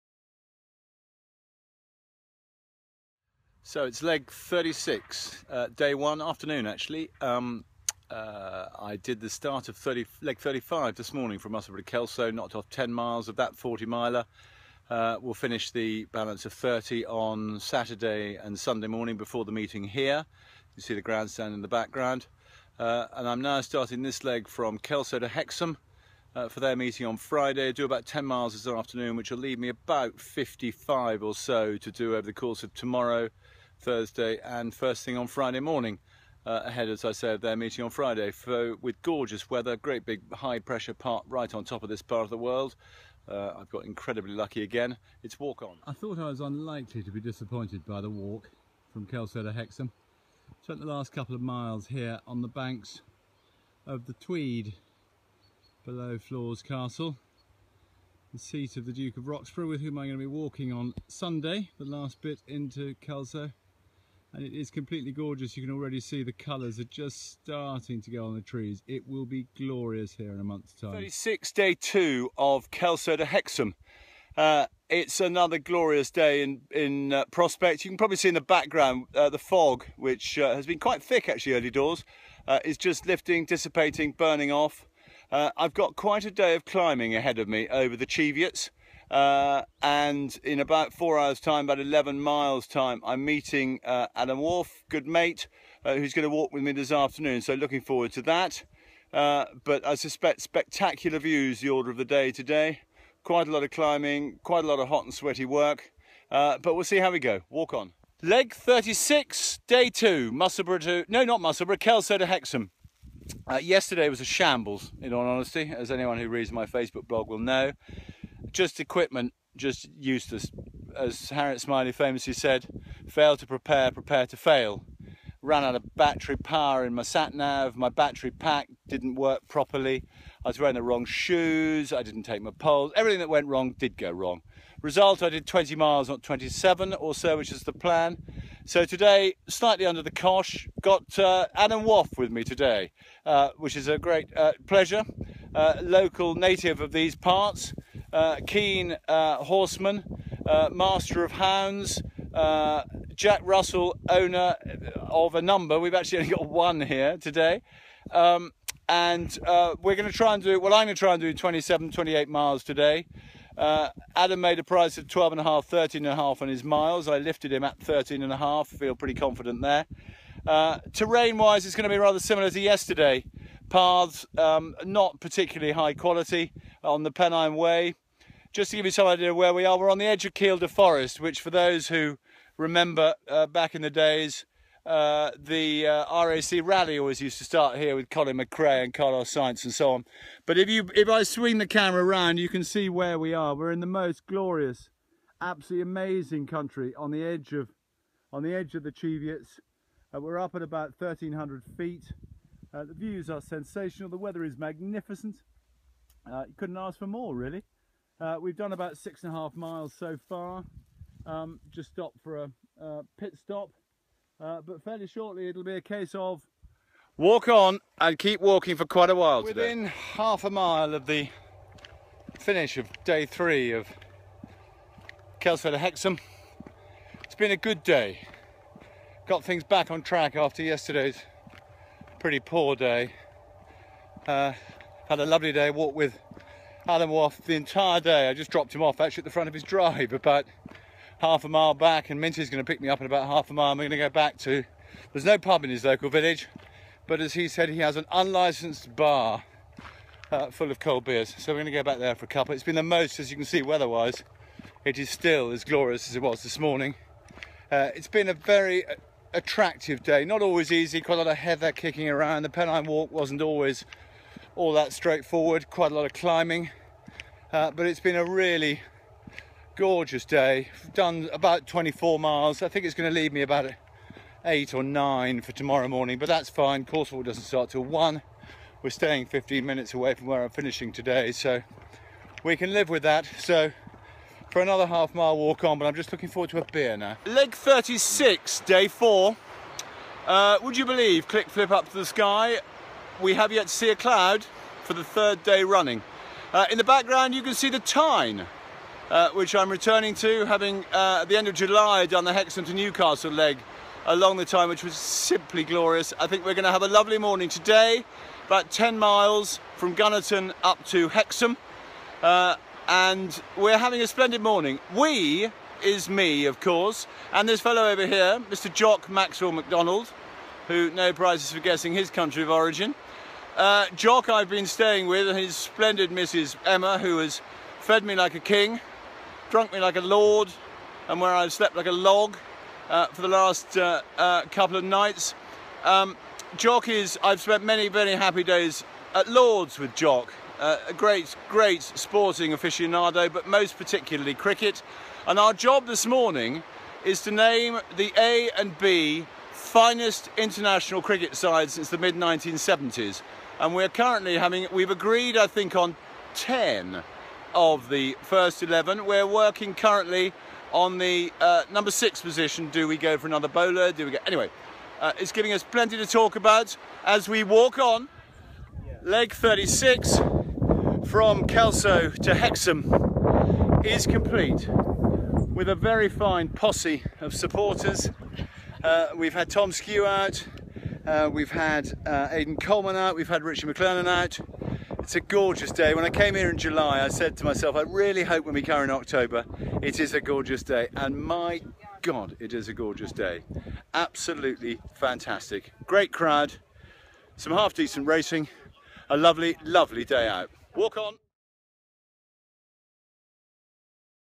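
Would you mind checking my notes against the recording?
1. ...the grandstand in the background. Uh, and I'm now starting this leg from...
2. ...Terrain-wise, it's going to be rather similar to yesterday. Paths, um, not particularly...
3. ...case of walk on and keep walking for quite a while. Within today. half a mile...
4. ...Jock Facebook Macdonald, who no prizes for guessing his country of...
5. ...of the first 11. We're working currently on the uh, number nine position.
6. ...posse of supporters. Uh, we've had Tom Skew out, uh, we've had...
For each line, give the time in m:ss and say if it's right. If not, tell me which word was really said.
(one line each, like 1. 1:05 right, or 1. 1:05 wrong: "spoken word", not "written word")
1. 0:20 right
2. 2:50 right
3. 3:35 right
4. 5:18 wrong: "Maxwell", not "Facebook"
5. 5:57 wrong: "six", not "nine"
6. 6:16 right.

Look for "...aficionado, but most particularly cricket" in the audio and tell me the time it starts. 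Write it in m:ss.
5:42.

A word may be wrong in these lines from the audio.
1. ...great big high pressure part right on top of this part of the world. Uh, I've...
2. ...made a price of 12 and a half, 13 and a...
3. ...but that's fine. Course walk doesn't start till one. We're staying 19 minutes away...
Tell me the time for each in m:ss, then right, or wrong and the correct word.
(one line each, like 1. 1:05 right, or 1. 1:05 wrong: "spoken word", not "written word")
1. 0:39 right
2. 2:44 right
3. 4:36 wrong: "15", not "19".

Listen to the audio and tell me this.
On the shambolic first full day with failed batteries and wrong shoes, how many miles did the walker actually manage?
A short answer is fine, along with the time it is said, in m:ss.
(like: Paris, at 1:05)
20, at 2:15.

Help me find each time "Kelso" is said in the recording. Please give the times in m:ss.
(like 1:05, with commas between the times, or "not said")
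0:11, 0:24, 0:49, 1:03, 1:12, 1:51, 3:45, 6:11.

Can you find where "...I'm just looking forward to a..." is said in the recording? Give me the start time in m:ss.
4:45.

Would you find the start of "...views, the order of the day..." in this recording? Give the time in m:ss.
1:41.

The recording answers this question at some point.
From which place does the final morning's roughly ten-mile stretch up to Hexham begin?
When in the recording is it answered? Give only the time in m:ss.
5:09.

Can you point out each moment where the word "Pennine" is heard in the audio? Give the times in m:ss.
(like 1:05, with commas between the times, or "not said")
2:57, 4:22.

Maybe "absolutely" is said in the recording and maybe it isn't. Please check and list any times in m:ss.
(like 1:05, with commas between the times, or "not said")
3:15, 6:33.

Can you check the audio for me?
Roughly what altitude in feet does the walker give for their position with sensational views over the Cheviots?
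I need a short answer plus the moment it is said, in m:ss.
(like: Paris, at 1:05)
1,300 feet, at 3:20.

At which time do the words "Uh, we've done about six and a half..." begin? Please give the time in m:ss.
3:28.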